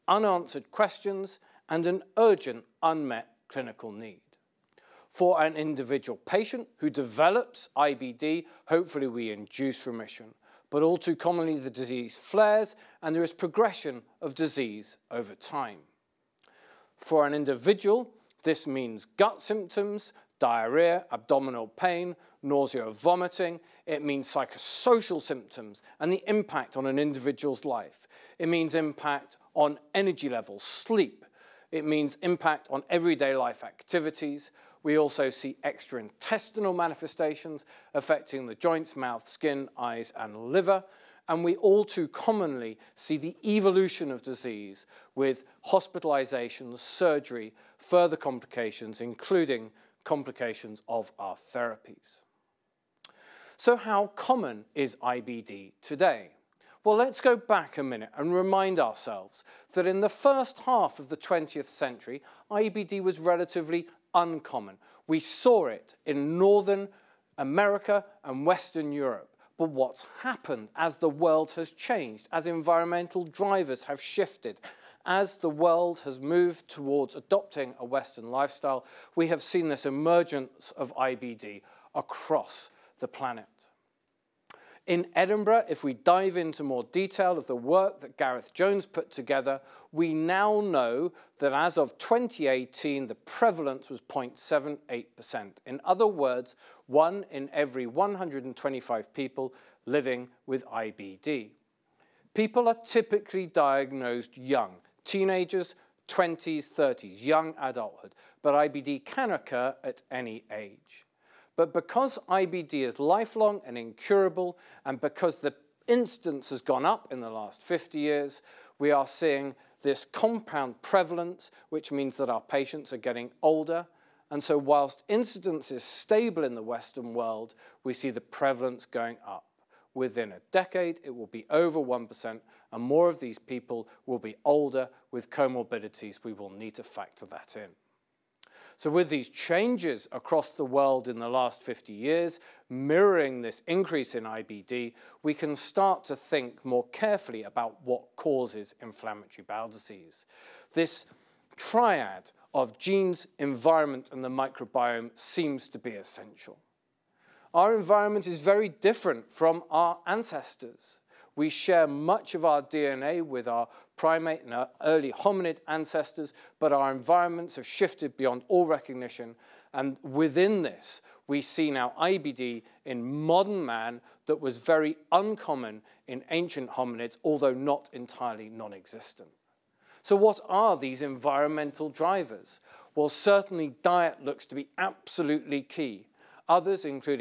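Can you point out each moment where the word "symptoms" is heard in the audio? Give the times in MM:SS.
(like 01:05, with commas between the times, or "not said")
00:19, 00:25.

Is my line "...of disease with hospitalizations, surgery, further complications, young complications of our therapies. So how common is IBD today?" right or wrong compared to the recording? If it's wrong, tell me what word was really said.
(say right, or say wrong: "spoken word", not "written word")
wrong: "including", not "young".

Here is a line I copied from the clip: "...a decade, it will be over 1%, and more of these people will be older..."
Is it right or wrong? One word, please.
right.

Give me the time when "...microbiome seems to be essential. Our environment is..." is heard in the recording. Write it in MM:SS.
02:34.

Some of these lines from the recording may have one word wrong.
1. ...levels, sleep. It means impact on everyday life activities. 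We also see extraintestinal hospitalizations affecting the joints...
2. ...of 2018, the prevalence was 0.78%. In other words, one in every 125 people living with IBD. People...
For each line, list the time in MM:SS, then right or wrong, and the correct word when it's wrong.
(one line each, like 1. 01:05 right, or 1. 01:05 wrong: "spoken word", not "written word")
1. 00:30 wrong: "manifestations", not "hospitalizations"
2. 01:31 right.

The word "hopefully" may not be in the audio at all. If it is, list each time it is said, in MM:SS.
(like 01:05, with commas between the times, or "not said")
00:08.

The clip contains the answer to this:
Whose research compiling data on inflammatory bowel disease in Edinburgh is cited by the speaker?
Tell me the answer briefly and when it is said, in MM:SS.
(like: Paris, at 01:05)
Gareth Jones, at 01:28.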